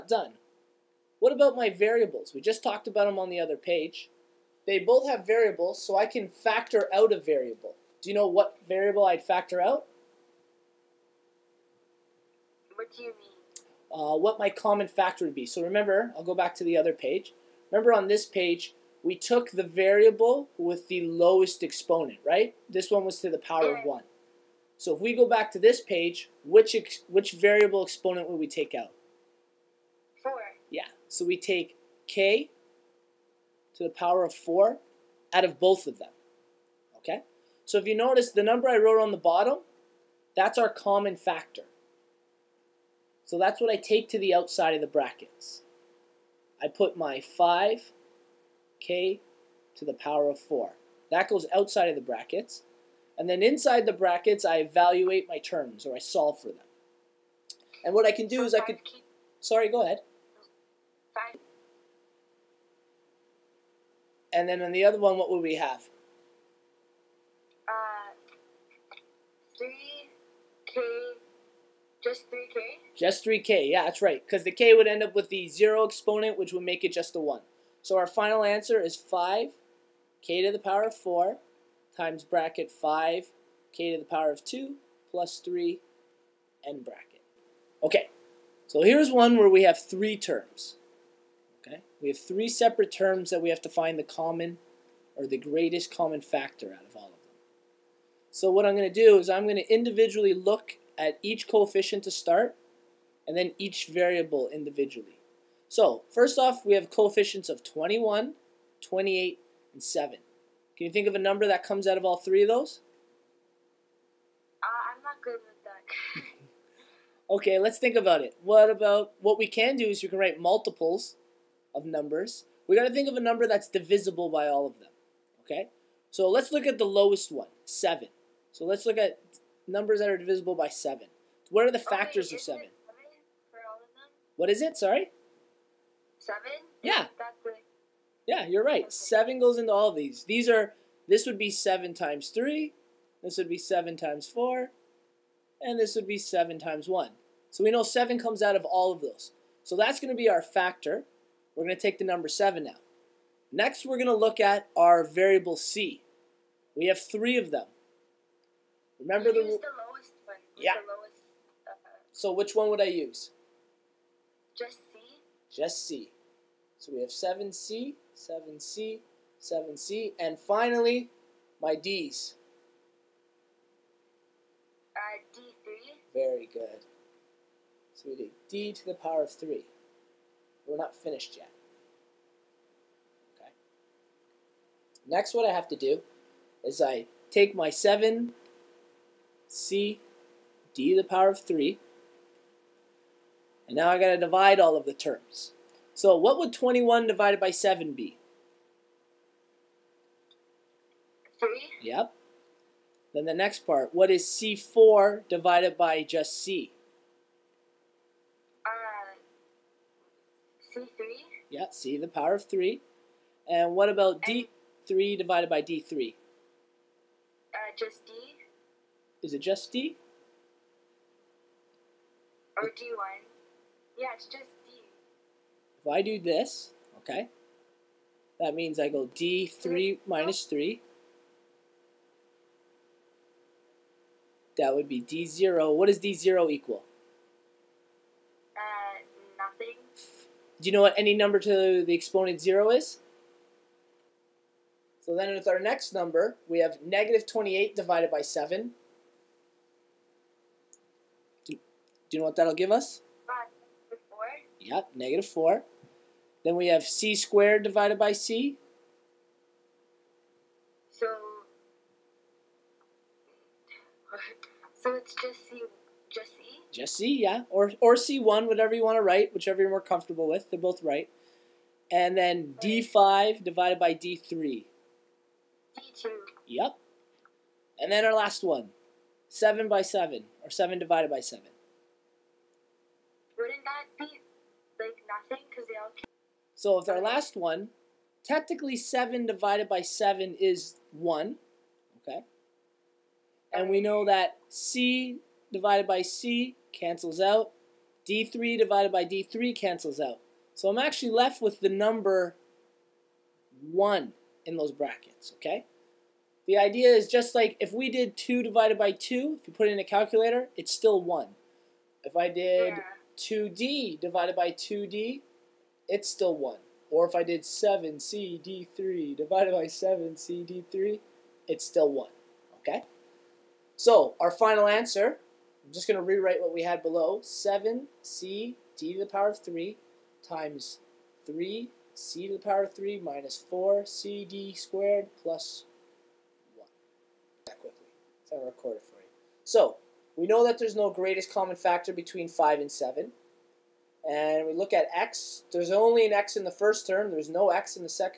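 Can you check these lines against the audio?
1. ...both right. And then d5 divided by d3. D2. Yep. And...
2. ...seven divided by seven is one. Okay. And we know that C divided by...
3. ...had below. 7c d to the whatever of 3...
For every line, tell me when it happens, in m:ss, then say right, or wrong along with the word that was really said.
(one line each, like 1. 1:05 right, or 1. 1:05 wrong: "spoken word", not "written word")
1. 4:30 right
2. 4:48 right
3. 5:26 wrong: "power", not "whatever".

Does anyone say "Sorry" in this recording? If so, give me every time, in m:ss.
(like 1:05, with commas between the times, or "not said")
0:59, 2:14.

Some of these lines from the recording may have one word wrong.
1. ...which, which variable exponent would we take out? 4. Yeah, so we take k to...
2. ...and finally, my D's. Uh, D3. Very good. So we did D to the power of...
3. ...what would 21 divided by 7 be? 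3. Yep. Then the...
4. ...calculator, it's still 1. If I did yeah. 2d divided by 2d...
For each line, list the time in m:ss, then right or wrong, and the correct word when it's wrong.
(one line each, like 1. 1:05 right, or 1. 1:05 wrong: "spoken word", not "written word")
1. 0:26 right
2. 2:50 right
3. 3:16 right
4. 5:09 right.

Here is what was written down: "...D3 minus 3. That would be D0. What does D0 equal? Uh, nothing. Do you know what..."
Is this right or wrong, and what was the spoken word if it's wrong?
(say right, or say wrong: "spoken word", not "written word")
right.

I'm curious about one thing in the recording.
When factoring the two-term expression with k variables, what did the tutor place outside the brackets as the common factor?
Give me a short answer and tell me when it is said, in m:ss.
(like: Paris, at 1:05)
5k^4, at 0:46.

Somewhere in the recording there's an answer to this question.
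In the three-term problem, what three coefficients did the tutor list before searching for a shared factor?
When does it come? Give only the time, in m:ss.
1:47.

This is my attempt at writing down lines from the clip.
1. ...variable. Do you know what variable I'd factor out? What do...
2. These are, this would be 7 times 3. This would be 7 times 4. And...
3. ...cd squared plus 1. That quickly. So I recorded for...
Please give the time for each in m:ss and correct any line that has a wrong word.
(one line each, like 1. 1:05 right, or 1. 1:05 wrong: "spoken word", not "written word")
1. 0:07 right
2. 2:20 right
3. 5:33 right.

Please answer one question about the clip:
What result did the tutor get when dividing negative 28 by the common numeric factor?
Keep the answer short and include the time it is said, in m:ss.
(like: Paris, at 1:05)
-4, at 4:14.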